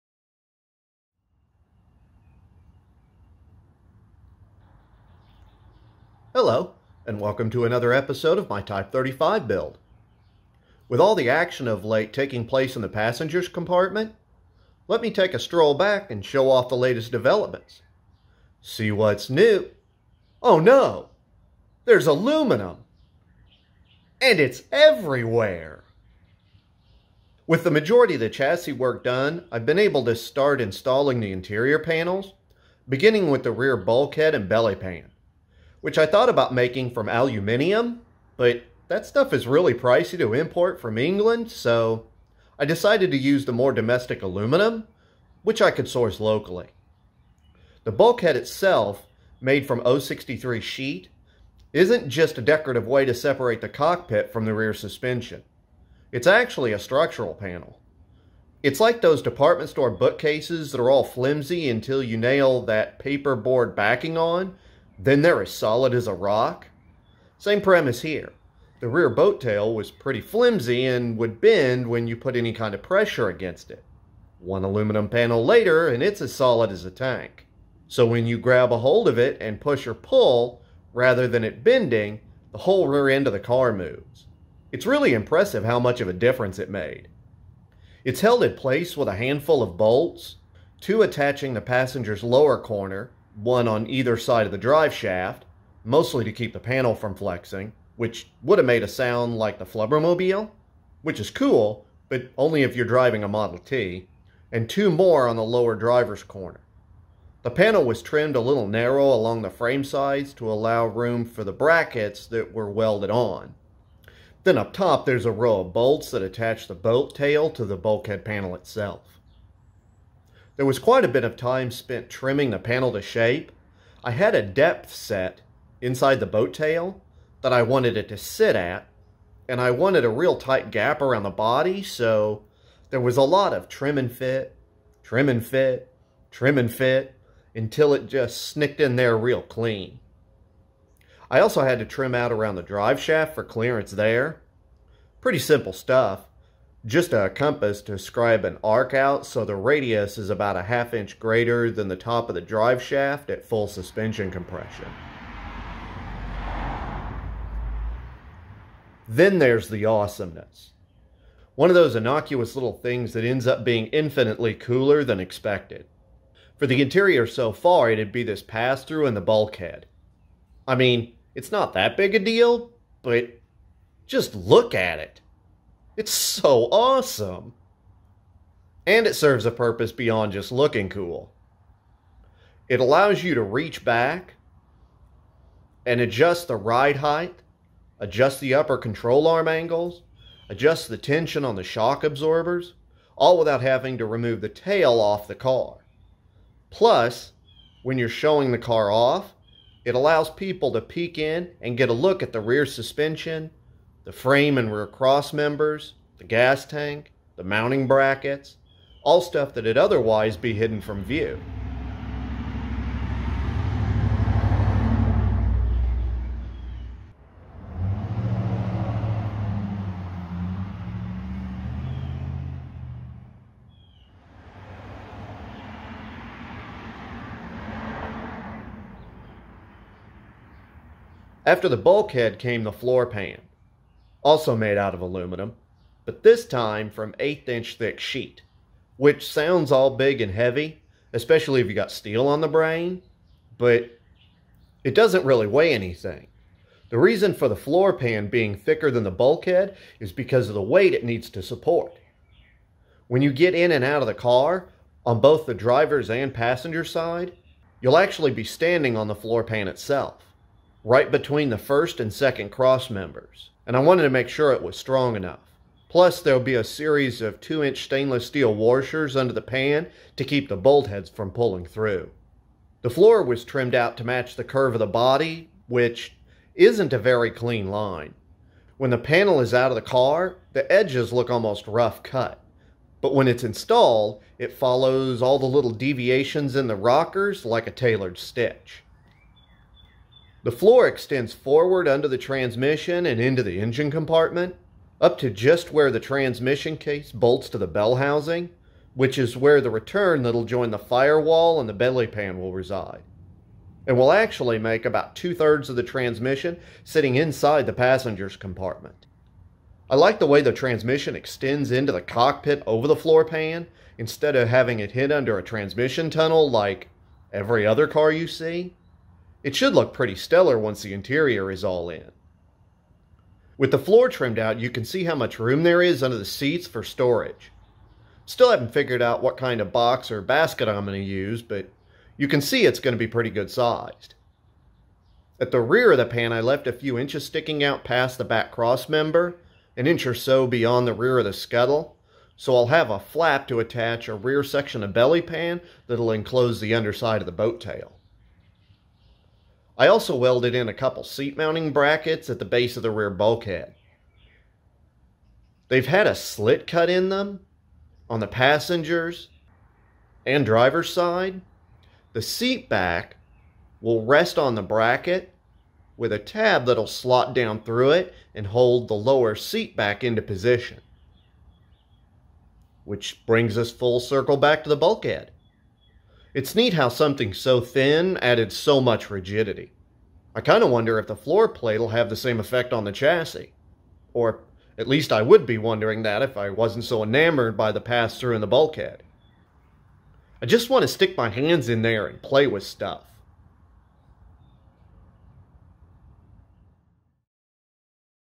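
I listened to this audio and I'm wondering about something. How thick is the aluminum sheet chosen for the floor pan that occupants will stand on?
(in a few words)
eighth inch.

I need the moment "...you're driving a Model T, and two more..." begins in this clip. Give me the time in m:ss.
1:42.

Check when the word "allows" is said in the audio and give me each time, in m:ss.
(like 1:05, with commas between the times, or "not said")
1:50, 3:02, 3:19.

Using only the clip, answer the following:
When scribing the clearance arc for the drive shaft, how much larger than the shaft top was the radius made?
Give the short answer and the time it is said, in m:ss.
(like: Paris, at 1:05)
half inch, at 2:30.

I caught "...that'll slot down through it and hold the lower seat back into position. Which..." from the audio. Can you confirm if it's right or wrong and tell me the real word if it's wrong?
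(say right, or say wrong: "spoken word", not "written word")
right.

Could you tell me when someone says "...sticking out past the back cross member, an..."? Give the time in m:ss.
5:37.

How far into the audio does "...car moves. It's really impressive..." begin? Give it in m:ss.
1:23.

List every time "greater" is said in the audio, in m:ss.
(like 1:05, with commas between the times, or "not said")
2:31.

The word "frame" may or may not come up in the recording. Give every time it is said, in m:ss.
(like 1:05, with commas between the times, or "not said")
1:49, 3:24.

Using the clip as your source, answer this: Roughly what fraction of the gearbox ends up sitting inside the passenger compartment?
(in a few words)
two thirds.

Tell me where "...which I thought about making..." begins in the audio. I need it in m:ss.
0:35.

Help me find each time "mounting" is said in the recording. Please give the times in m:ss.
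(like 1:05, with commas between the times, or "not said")
3:27, 5:51.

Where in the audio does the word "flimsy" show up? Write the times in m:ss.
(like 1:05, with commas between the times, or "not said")
1:01, 1:10.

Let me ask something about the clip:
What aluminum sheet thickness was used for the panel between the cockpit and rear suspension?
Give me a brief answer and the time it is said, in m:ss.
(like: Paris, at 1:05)
063, at 0:49.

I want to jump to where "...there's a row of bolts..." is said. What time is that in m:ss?
1:55.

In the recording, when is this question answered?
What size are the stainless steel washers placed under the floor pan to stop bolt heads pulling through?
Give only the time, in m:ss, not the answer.
4:27.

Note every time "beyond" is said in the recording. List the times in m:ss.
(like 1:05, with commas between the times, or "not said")
2:59, 5:40.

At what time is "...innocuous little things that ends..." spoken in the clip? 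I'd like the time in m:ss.
2:41.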